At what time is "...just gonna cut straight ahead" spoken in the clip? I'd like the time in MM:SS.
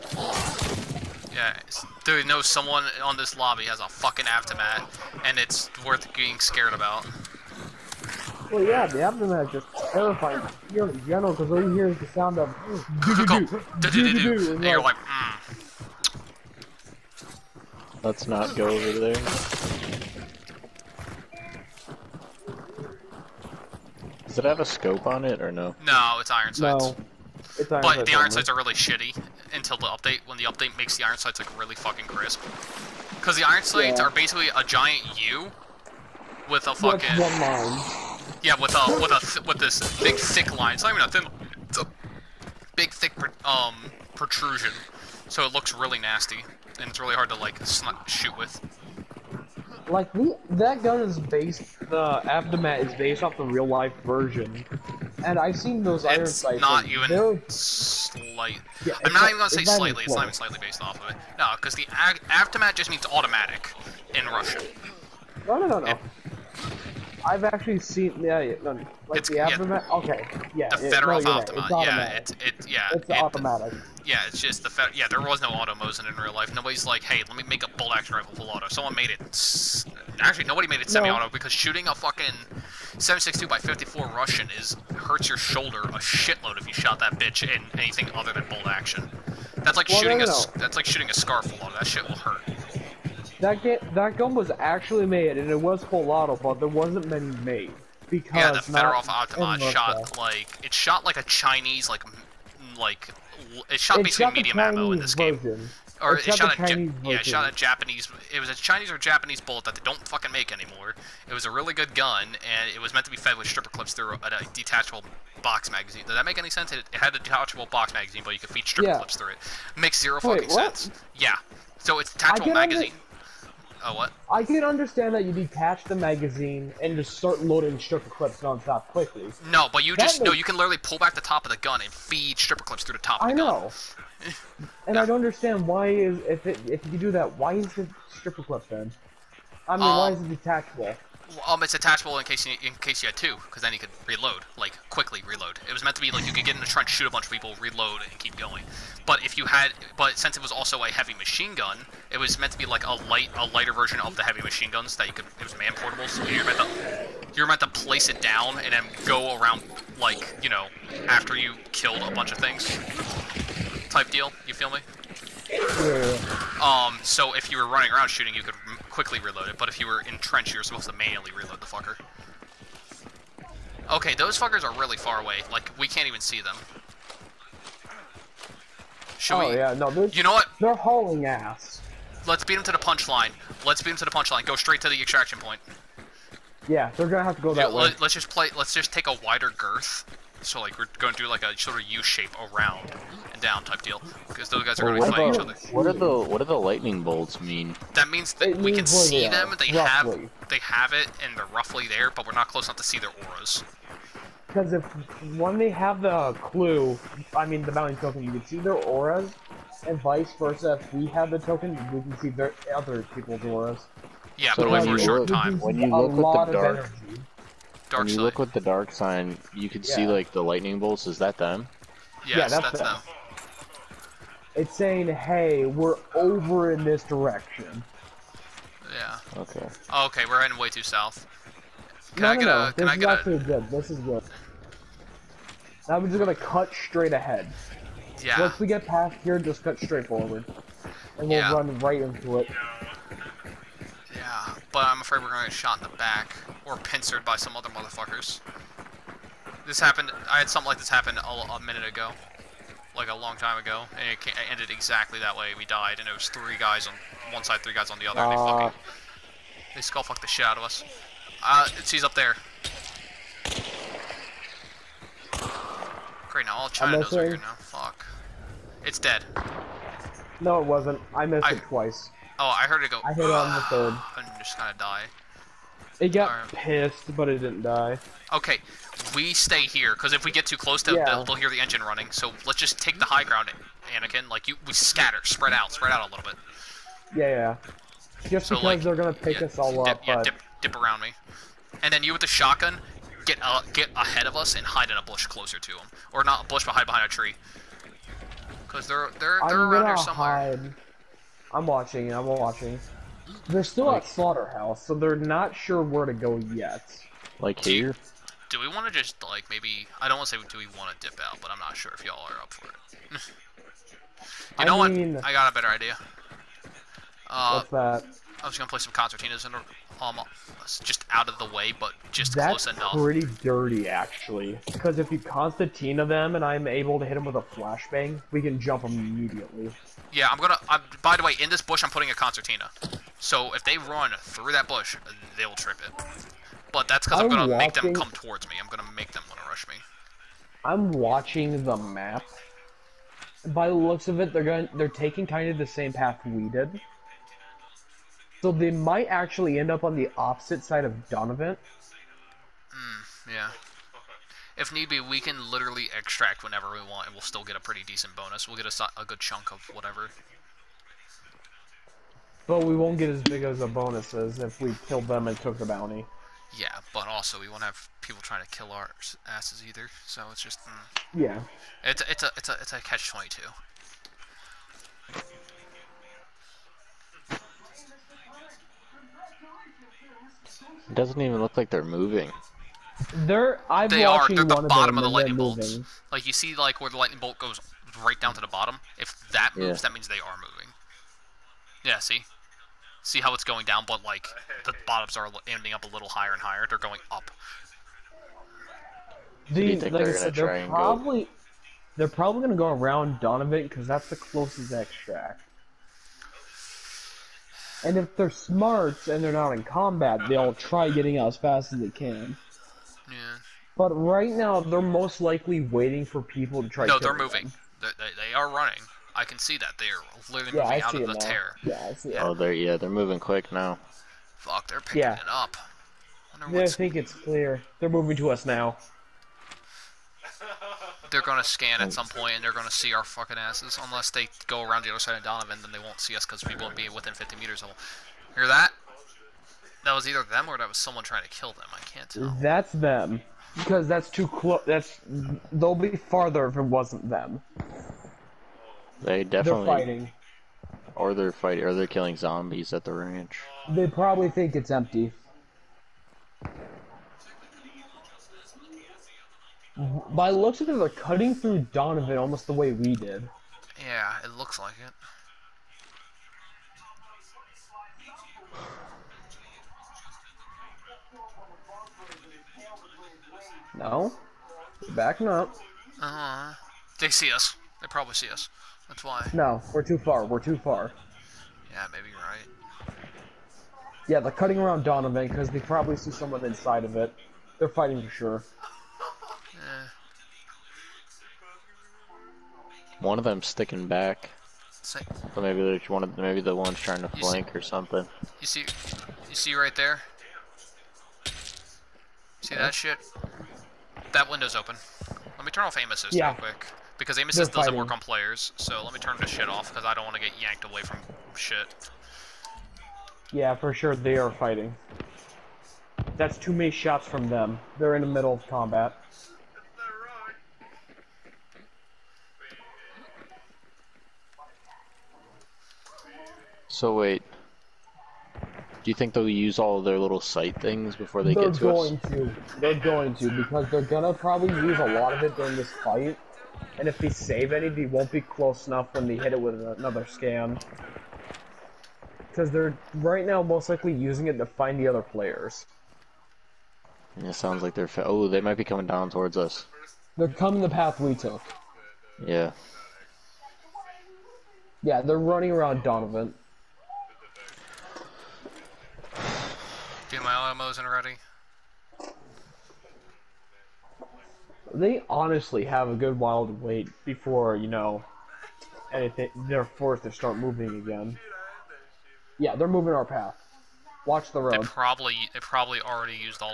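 03:56.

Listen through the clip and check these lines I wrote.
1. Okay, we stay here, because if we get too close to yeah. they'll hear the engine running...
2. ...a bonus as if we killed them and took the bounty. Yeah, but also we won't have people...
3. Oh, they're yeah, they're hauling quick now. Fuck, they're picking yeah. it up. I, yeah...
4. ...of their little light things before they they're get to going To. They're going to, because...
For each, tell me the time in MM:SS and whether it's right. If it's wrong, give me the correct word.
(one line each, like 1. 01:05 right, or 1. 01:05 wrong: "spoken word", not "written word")
1. 04:38 right
2. 06:03 right
3. 07:02 wrong: "moving", not "hauling"
4. 08:49 wrong: "sight", not "light".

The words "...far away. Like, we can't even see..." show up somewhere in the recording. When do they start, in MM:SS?
02:54.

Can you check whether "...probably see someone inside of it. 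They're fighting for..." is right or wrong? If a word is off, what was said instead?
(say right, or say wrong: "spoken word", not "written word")
right.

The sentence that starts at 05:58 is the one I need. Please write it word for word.
We'll get a, a good chunk of whatever.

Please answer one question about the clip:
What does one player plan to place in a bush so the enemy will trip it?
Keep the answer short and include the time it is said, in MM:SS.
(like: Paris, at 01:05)
Concertinas, at 05:18.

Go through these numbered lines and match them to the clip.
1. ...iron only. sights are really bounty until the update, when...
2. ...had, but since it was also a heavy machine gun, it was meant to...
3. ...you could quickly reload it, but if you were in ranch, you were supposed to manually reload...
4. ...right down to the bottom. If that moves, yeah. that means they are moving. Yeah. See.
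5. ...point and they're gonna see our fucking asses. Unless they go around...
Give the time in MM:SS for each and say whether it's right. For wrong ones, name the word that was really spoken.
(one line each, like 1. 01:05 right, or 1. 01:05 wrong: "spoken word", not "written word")
1. 00:28 wrong: "shitty", not "bounty"
2. 02:29 right
3. 02:48 wrong: "trench", not "ranch"
4. 06:28 right
5. 07:12 right.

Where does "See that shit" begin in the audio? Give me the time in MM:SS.
08:22.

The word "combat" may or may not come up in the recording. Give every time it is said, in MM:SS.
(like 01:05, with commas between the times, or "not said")
06:49, 08:38.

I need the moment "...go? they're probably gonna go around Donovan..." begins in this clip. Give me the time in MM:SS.
06:41.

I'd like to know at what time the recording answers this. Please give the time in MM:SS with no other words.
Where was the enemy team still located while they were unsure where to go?
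05:04.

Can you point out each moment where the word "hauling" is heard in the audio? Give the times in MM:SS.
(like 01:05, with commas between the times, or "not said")
03:00.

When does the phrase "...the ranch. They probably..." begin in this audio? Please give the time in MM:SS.
07:32.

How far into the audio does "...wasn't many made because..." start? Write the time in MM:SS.
01:36.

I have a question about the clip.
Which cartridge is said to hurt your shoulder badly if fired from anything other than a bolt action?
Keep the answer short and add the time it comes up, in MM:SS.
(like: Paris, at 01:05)
7.62x54 Russian, at 01:22.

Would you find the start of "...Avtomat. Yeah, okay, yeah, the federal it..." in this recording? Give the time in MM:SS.
01:09.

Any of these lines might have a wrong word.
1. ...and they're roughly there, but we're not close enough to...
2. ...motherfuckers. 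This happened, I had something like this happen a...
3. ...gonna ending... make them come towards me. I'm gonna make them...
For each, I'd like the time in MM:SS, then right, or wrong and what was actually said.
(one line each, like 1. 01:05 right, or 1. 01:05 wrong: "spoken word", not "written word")
1. 03:21 right
2. 04:07 right
3. 05:37 wrong: "watching", not "ending".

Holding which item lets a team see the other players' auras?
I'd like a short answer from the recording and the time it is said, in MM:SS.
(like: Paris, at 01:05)
The mounting token, at 03:27.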